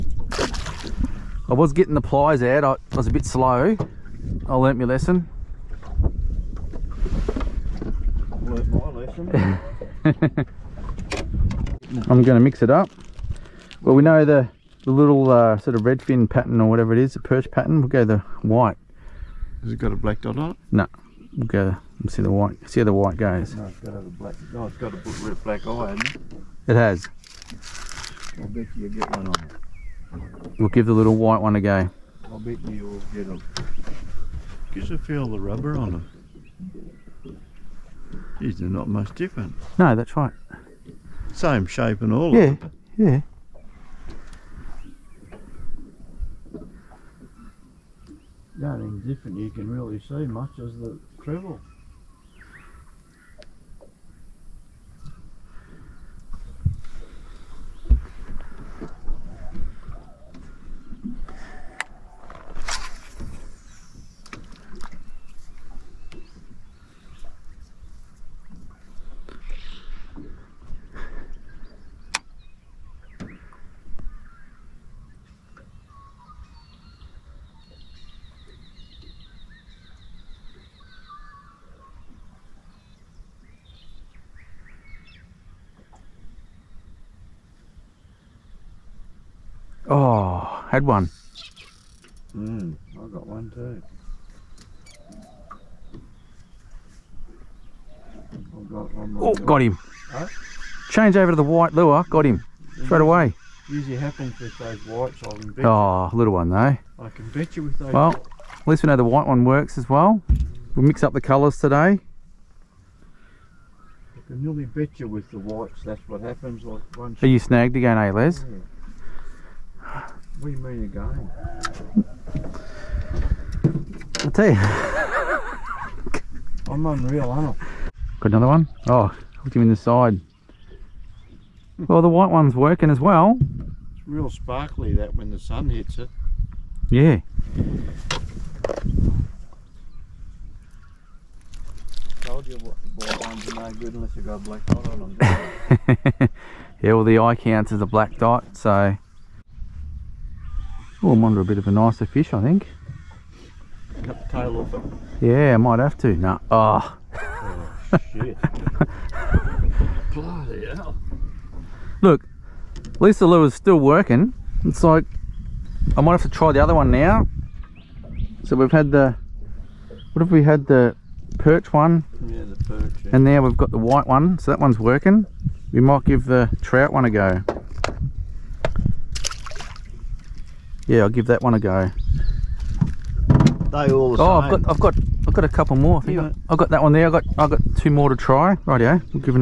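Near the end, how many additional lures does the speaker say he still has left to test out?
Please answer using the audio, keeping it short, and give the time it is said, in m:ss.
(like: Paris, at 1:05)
2, at 3:07.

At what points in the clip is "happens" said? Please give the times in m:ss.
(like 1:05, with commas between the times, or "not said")
1:43, 1:56.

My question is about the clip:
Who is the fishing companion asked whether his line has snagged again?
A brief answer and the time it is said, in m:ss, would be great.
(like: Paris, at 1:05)
Les, at 1:58.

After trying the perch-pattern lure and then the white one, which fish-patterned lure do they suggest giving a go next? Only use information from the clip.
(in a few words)
trout.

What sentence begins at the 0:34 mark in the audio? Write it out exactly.
Gives a feel of the rubber on them.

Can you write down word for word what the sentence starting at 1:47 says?
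Well, at least we know the white one works as well.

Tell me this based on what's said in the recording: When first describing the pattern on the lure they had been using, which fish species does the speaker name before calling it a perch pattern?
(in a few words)
redfin.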